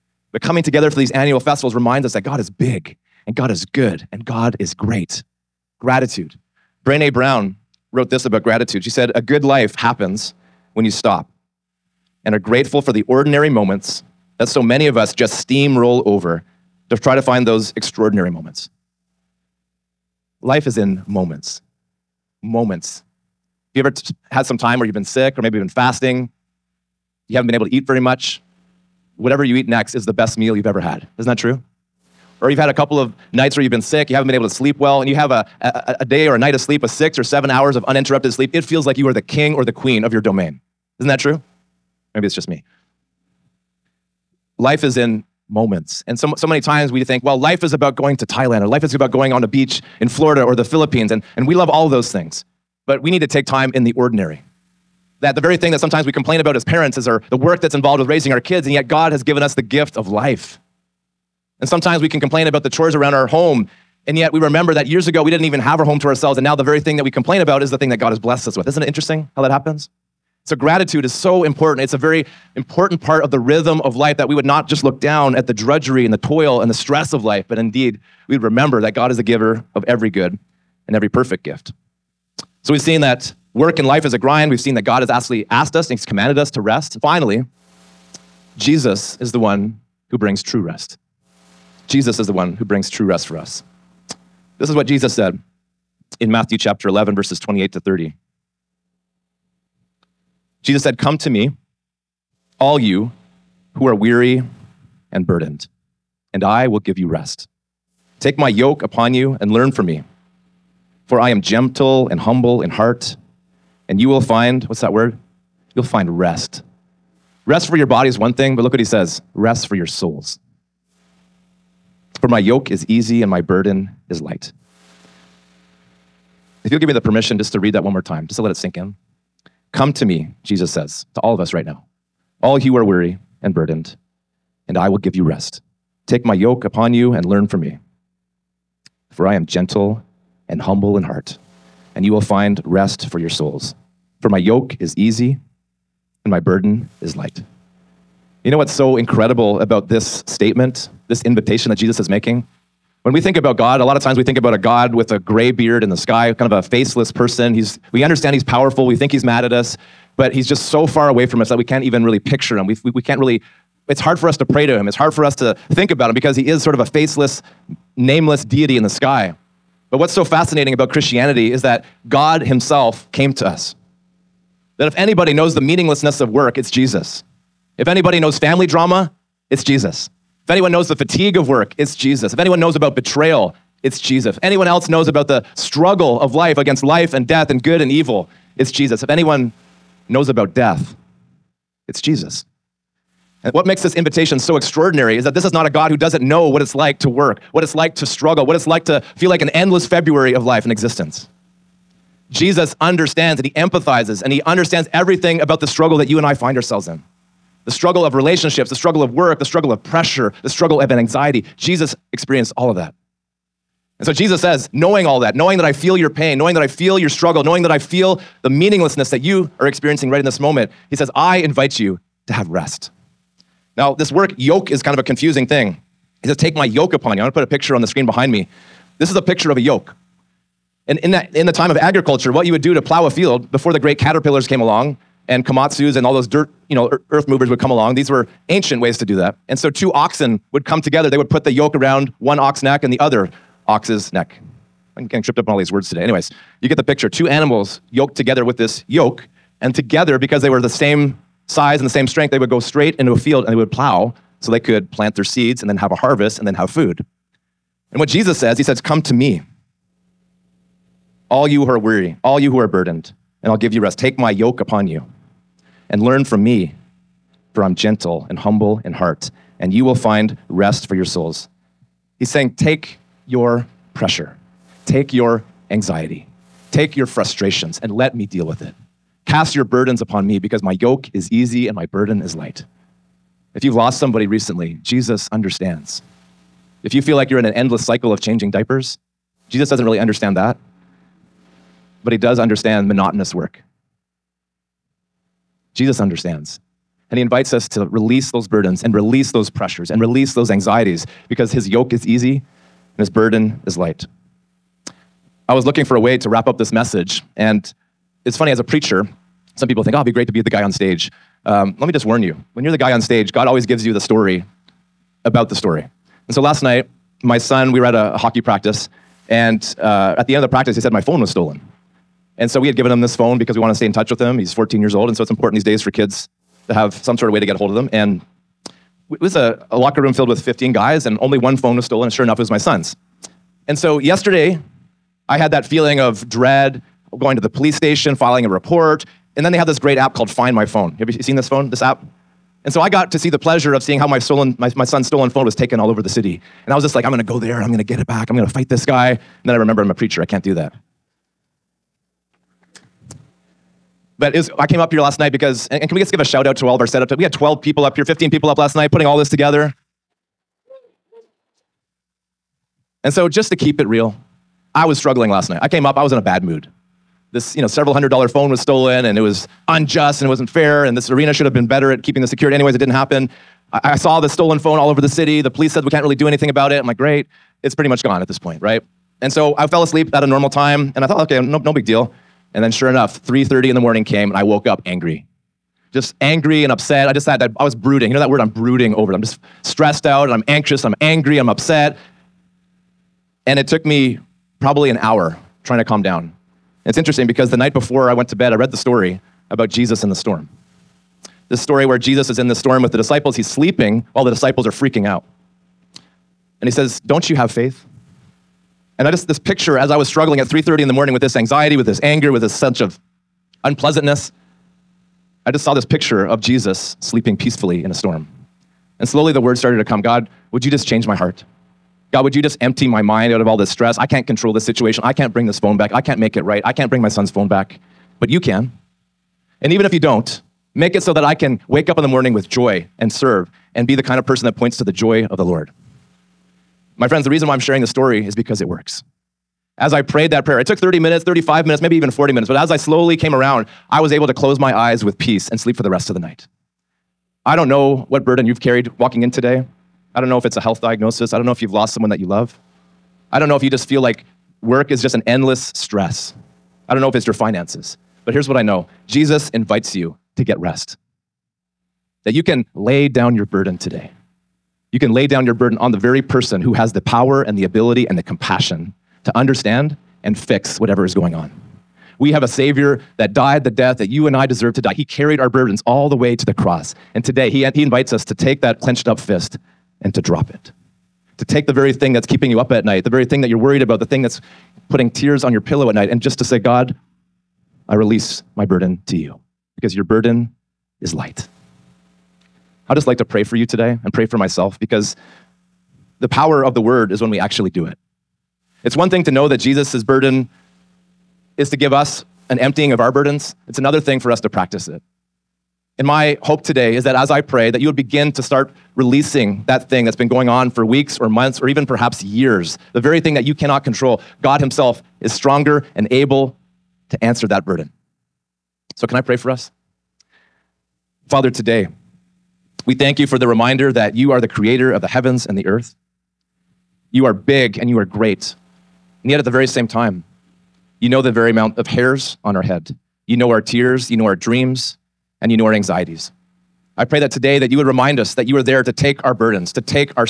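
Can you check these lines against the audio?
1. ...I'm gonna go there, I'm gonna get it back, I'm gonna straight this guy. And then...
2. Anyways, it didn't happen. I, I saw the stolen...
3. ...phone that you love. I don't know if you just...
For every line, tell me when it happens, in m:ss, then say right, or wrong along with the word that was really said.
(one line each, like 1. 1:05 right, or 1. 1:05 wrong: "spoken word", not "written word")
1. 5:47 wrong: "fight", not "straight"
2. 6:12 right
3. 7:31 wrong: "someone", not "phone".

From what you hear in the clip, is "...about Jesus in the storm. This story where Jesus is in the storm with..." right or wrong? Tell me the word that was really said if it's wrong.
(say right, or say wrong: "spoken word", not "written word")
right.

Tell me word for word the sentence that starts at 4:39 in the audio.
Cast your burdens upon me because my yoke is easy and my burden is light.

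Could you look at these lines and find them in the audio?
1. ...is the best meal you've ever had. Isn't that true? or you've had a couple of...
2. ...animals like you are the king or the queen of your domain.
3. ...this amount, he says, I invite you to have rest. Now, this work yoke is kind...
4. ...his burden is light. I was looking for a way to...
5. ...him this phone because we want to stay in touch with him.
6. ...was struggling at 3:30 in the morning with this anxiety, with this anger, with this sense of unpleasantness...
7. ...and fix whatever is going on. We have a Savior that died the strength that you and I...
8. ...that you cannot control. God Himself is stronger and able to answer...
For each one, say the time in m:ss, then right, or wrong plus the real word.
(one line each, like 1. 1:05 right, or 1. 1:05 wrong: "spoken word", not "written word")
1. 0:29 right
2. 0:38 wrong: "feels", not "animals"
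3. 3:40 wrong: "moment", not "amount"
4. 5:03 right
5. 5:22 right
6. 6:49 right
7. 7:50 wrong: "death", not "strength"
8. 8:33 right.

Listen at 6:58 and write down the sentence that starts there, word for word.
And slowly the word started to come God, would you just change my heart?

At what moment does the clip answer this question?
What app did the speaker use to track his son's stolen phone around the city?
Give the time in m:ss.
5:40.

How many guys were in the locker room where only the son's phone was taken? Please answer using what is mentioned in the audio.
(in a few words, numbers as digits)
15.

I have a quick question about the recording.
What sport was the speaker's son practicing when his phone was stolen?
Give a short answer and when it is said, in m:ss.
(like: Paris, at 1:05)
Hockey, at 5:18.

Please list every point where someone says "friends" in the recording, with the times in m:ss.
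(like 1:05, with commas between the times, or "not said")
7:17.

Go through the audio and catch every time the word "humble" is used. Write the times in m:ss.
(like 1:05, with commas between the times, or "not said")
1:52, 2:20, 4:28.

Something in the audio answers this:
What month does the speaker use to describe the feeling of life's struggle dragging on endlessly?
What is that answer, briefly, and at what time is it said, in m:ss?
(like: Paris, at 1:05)
February, at 3:19.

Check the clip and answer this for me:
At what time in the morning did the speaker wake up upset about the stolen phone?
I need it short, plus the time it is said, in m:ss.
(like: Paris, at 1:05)
3:30, at 6:23.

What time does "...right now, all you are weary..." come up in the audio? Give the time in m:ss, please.
2:11.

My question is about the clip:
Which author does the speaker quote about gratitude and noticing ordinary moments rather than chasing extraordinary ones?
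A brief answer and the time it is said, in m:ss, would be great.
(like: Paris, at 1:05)
Brene Brown, at 0:06.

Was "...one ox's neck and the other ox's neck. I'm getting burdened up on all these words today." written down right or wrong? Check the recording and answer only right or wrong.
wrong.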